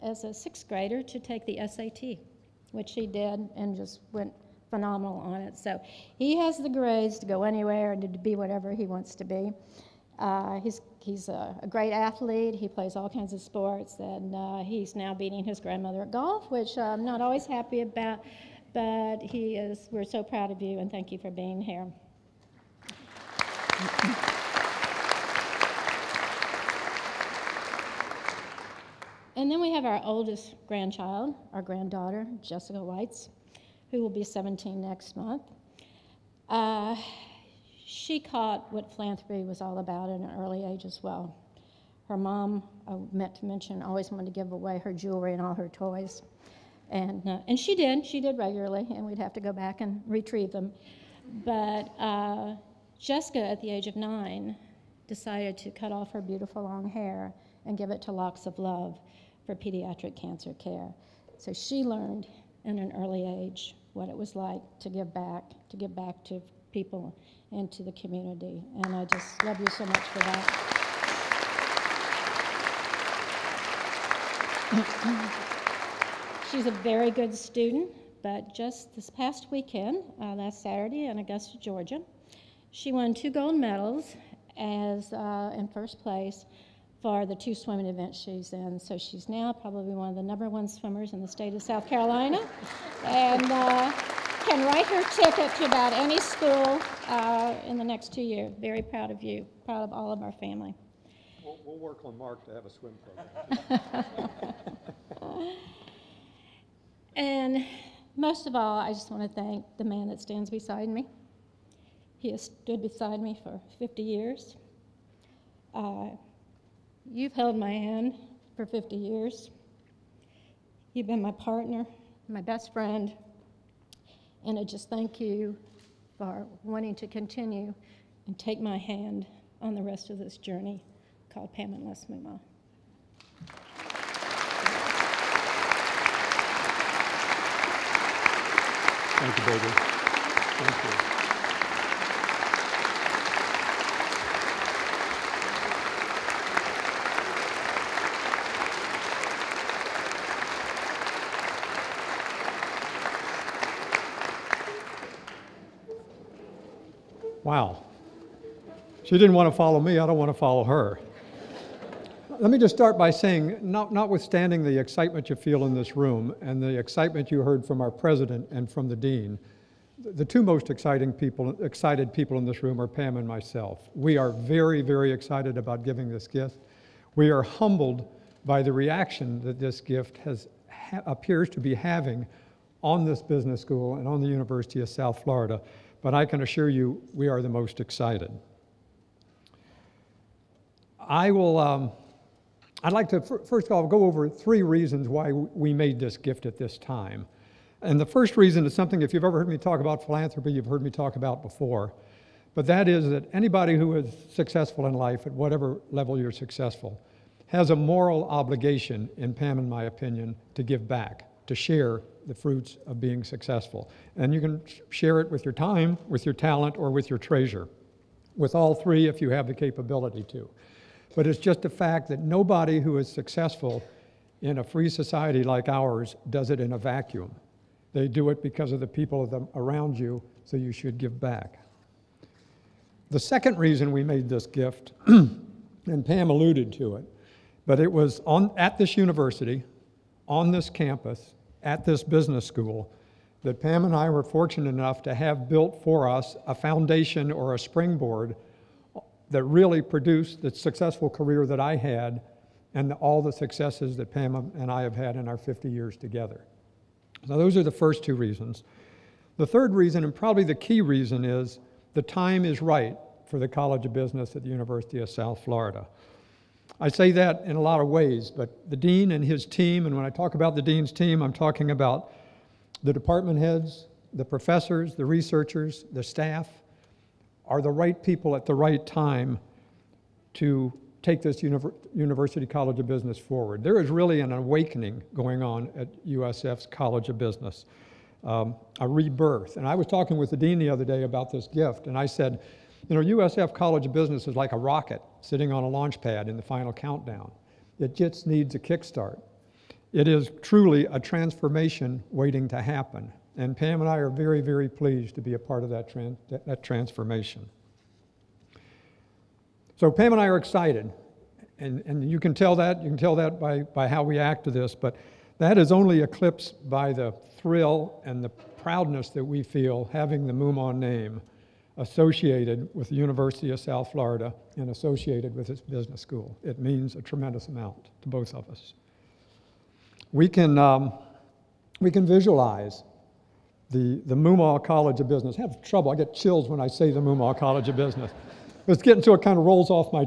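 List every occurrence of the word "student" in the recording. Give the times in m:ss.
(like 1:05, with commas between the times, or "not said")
1:17.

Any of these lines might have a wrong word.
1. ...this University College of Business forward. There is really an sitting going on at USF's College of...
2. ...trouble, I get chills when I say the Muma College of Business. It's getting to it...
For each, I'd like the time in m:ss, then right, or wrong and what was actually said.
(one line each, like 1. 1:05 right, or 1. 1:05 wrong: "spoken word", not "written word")
1. 4:41 wrong: "awakening", not "sitting"
2. 5:35 right.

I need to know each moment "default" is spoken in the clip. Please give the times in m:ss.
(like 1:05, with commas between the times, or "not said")
not said.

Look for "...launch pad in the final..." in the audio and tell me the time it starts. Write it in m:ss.
4:55.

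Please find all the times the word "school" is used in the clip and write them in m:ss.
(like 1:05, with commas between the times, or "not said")
1:36, 3:03, 4:02, 5:25.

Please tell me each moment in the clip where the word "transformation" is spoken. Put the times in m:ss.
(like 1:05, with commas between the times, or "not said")
5:00, 5:06.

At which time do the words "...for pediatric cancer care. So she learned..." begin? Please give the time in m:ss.
0:59.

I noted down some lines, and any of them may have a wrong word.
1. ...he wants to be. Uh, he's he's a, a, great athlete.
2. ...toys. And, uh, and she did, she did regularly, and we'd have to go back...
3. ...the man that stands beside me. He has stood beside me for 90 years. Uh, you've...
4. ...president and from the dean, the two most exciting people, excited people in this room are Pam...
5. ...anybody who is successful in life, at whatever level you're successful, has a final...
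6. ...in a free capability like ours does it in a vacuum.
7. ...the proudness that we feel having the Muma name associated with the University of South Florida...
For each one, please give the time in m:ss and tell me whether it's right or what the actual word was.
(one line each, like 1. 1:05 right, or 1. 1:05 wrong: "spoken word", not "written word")
1. 0:08 right
2. 0:45 right
3. 1:49 wrong: "50", not "90"
4. 2:47 right
5. 3:23 wrong: "moral", not "final"
6. 3:44 wrong: "society", not "capability"
7. 5:18 right.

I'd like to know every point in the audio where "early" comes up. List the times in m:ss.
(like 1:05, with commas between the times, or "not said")
0:40, 1:02.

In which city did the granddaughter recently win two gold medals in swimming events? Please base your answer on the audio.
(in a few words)
Augusta, Georgia.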